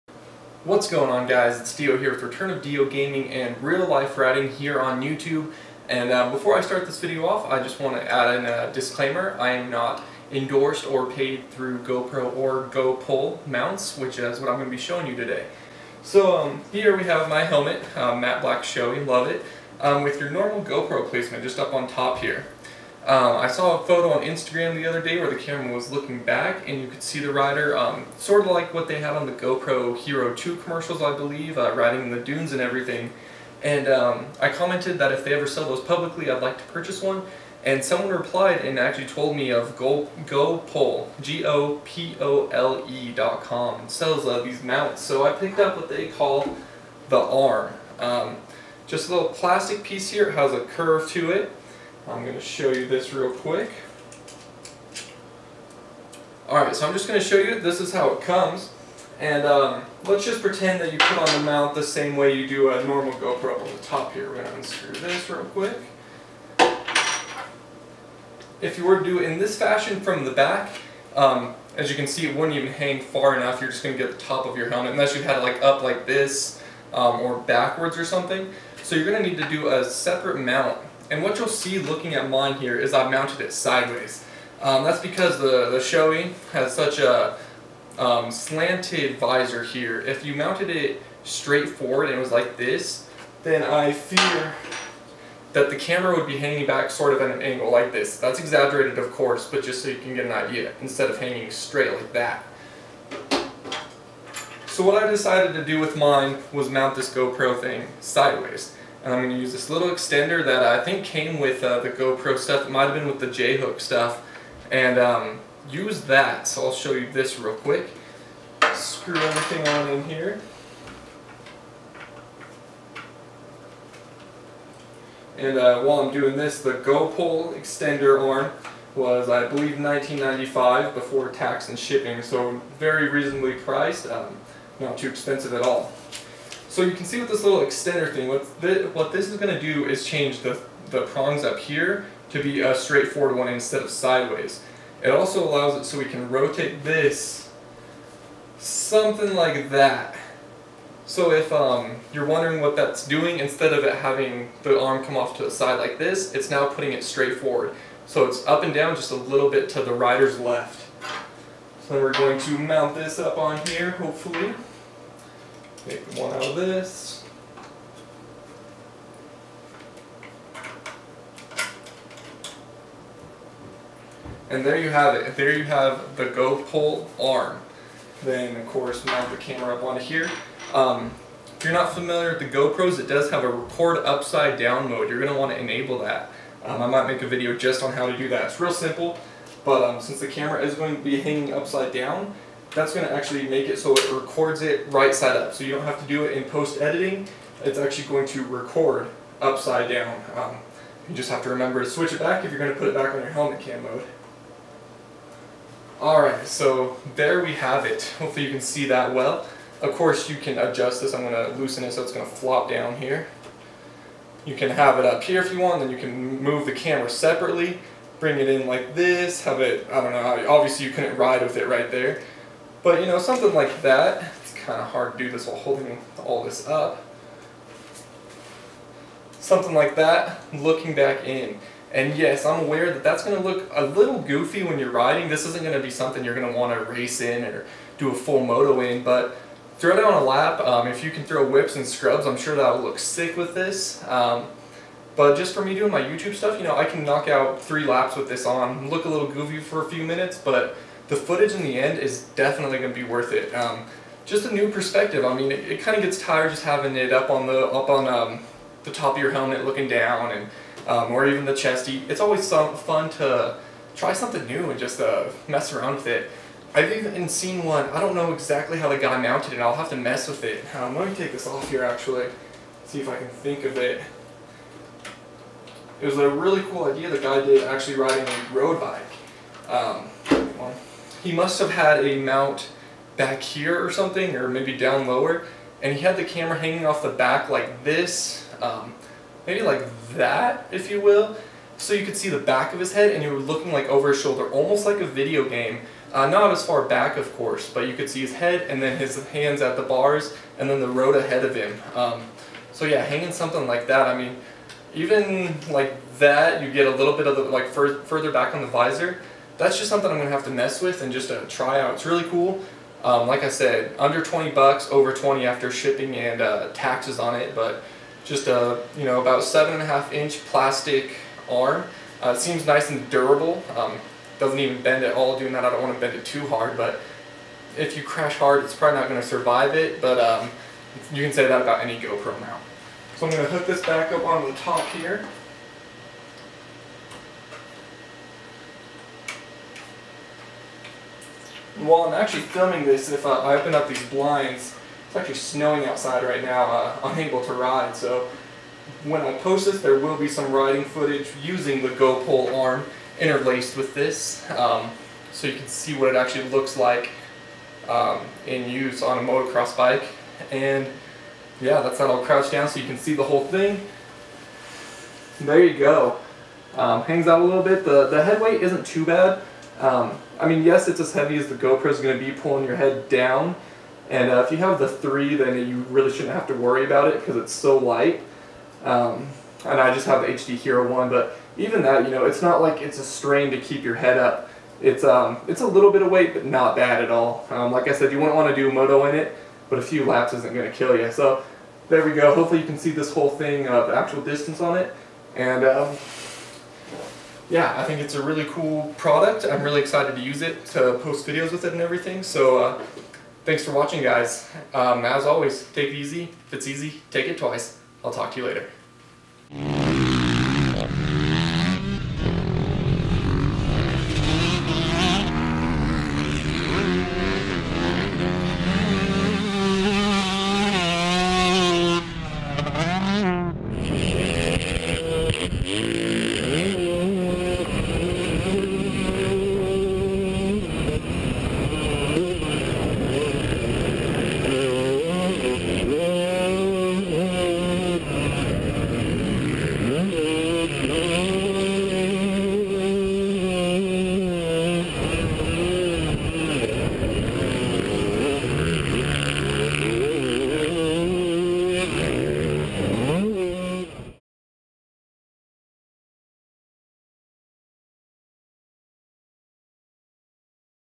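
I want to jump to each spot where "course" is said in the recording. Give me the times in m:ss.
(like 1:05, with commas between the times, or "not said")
1:39, 2:58, 3:29, 4:57.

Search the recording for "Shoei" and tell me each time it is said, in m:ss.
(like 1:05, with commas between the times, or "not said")
0:18, 1:25.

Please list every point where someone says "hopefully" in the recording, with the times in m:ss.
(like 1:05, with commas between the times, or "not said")
2:43, 3:28, 6:32.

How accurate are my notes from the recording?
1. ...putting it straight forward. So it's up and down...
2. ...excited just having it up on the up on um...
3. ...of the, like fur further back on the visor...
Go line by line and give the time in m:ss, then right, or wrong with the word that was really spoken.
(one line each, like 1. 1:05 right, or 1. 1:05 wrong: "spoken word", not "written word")
1. 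2:36 right
2. 4:16 wrong: "tired", not "excited"
3. 5:07 right.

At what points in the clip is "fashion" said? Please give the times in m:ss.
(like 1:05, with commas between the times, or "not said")
1:09.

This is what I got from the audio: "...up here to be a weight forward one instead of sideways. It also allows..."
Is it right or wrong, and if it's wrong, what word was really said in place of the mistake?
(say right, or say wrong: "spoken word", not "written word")
wrong: "straight", not "weight".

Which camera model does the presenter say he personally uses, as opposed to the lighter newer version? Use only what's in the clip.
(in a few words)
HD Hero 1.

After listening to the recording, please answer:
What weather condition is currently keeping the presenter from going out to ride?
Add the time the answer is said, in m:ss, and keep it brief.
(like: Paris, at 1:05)
Snowing, at 5:45.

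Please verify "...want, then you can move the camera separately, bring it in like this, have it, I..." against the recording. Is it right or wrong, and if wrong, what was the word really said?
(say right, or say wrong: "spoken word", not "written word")
right.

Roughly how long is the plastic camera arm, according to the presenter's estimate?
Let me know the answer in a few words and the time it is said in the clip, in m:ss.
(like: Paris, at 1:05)
7.5 inches, at 5:19.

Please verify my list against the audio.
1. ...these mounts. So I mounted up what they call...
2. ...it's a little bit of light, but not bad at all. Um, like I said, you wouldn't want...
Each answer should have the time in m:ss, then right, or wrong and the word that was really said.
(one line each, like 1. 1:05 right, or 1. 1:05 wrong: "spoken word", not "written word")
1. 0:44 wrong: "picked", not "mounted"
2. 6:25 wrong: "weight", not "light".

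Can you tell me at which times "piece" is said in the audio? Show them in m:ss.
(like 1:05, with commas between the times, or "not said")
0:49.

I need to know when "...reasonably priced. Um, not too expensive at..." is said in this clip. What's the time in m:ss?
2:13.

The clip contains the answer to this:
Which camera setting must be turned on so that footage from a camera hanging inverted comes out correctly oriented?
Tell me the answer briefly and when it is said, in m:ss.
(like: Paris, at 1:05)
Record upside down mode, at 3:03.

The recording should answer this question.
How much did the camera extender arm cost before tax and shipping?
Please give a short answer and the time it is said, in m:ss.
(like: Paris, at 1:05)
$19.95, at 2:09.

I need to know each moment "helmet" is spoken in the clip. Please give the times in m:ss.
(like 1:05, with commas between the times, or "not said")
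0:17, 1:14, 3:23, 4:19.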